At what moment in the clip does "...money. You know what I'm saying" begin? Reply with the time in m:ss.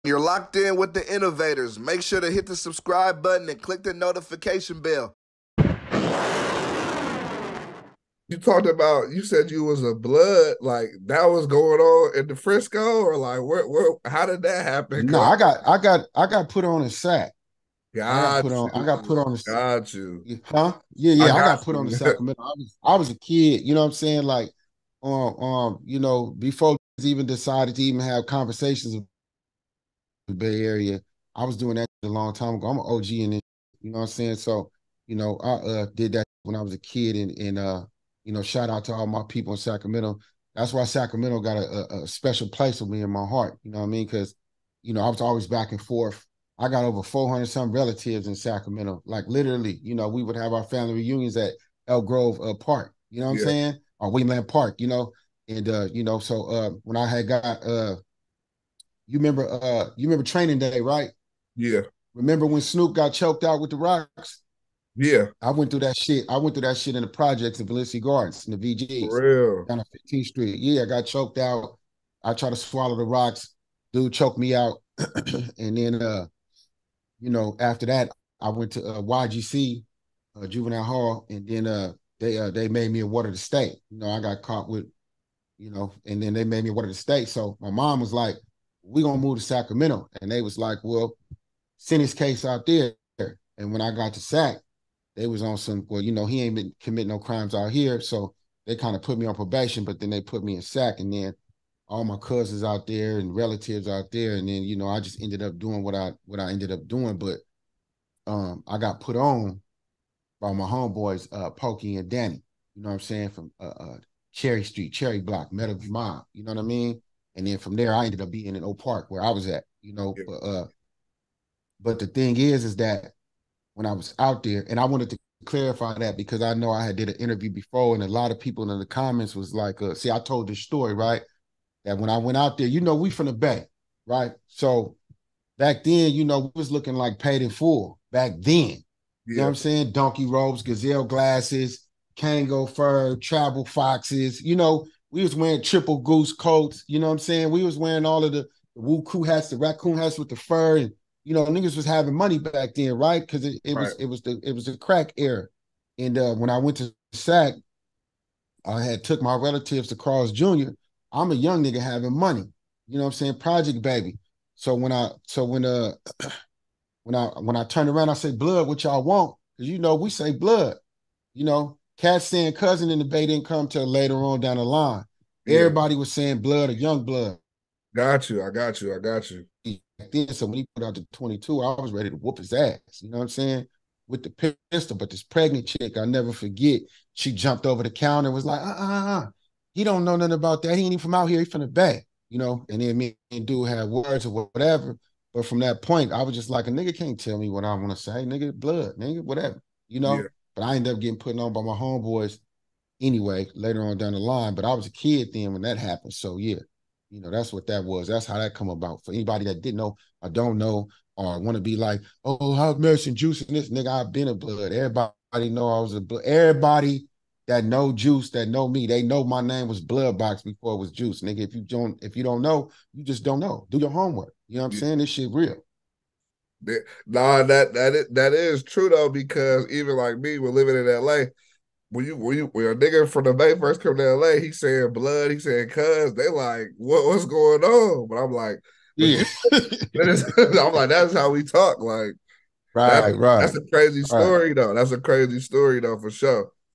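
2:42.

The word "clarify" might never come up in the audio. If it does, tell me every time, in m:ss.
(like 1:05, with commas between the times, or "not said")
2:05.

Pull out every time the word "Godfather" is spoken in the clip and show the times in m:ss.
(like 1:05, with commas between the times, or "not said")
not said.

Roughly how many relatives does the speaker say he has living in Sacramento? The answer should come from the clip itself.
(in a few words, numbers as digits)
400.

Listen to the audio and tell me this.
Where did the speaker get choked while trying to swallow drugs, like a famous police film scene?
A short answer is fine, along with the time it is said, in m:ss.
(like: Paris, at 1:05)
Valencia Gardens, at 1:07.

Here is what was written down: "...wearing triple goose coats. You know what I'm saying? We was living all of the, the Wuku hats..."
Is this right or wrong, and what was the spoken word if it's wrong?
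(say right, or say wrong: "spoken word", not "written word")
wrong: "wearing", not "living".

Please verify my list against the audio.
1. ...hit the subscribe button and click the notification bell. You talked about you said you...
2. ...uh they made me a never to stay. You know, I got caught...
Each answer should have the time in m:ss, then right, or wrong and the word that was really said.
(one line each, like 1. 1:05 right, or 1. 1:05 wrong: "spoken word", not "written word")
1. 0:02 right
2. 1:22 wrong: "water", not "never".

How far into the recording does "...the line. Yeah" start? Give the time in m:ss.
2:54.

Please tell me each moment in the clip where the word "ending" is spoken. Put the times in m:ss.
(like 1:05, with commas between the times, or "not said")
not said.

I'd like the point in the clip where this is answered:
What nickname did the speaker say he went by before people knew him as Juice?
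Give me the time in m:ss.
3:39.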